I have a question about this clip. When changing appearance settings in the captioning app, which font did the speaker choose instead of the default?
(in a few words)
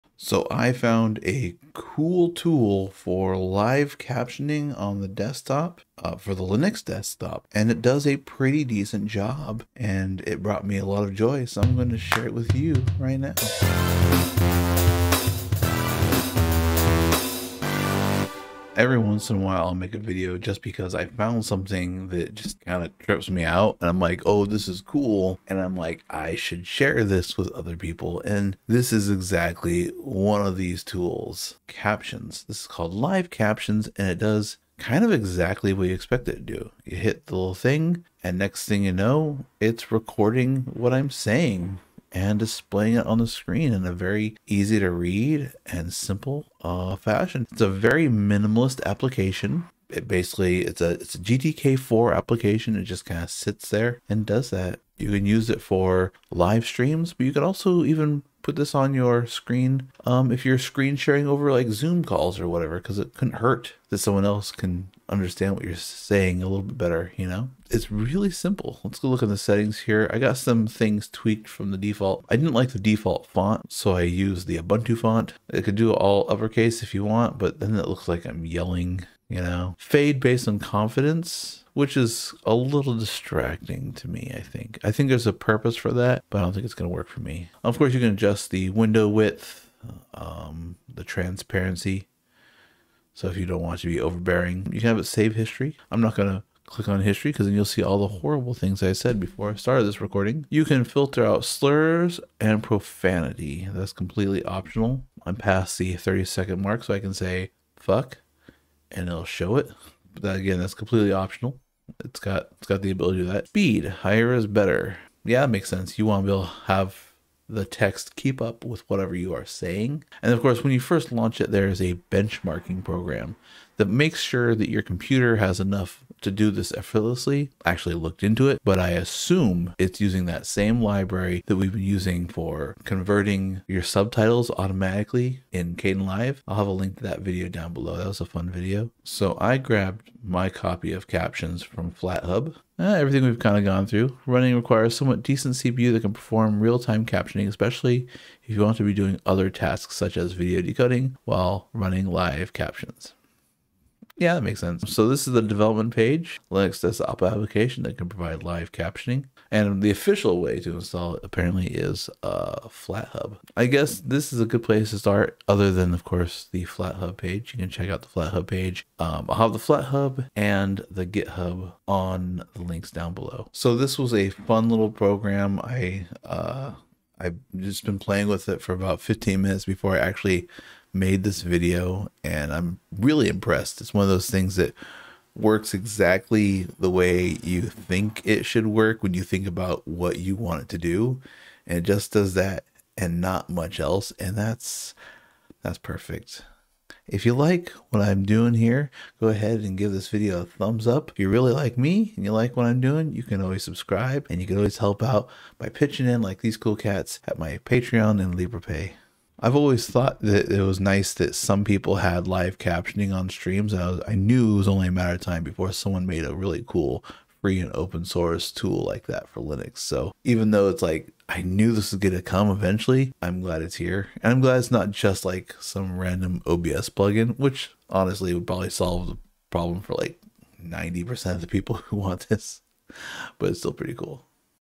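Ubuntu.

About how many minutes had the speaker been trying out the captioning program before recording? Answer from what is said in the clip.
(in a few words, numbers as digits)
15 minutes.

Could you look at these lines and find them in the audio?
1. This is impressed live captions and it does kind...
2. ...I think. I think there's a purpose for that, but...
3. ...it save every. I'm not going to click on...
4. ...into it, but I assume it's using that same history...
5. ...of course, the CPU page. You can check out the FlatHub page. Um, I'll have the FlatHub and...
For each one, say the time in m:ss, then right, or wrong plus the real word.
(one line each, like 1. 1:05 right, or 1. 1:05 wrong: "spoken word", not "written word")
1. 0:32 wrong: "called", not "impressed"
2. 1:24 right
3. 1:34 wrong: "history", not "every"
4. 2:08 wrong: "library", not "history"
5. 2:45 wrong: "FlatHub", not "CPU".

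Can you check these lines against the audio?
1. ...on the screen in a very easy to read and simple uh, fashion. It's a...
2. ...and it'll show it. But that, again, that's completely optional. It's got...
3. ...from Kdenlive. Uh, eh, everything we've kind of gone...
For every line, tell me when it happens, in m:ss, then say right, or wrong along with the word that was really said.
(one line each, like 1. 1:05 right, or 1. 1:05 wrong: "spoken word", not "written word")
1. 0:43 right
2. 1:48 right
3. 2:21 wrong: "FlatHub", not "Kdenlive".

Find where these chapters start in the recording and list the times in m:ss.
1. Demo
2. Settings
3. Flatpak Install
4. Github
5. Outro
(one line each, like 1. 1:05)
1. 0:31
2. 1:08
3. 2:18
4. 2:34
5. 3:29.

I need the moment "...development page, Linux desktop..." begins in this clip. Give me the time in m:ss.
2:35.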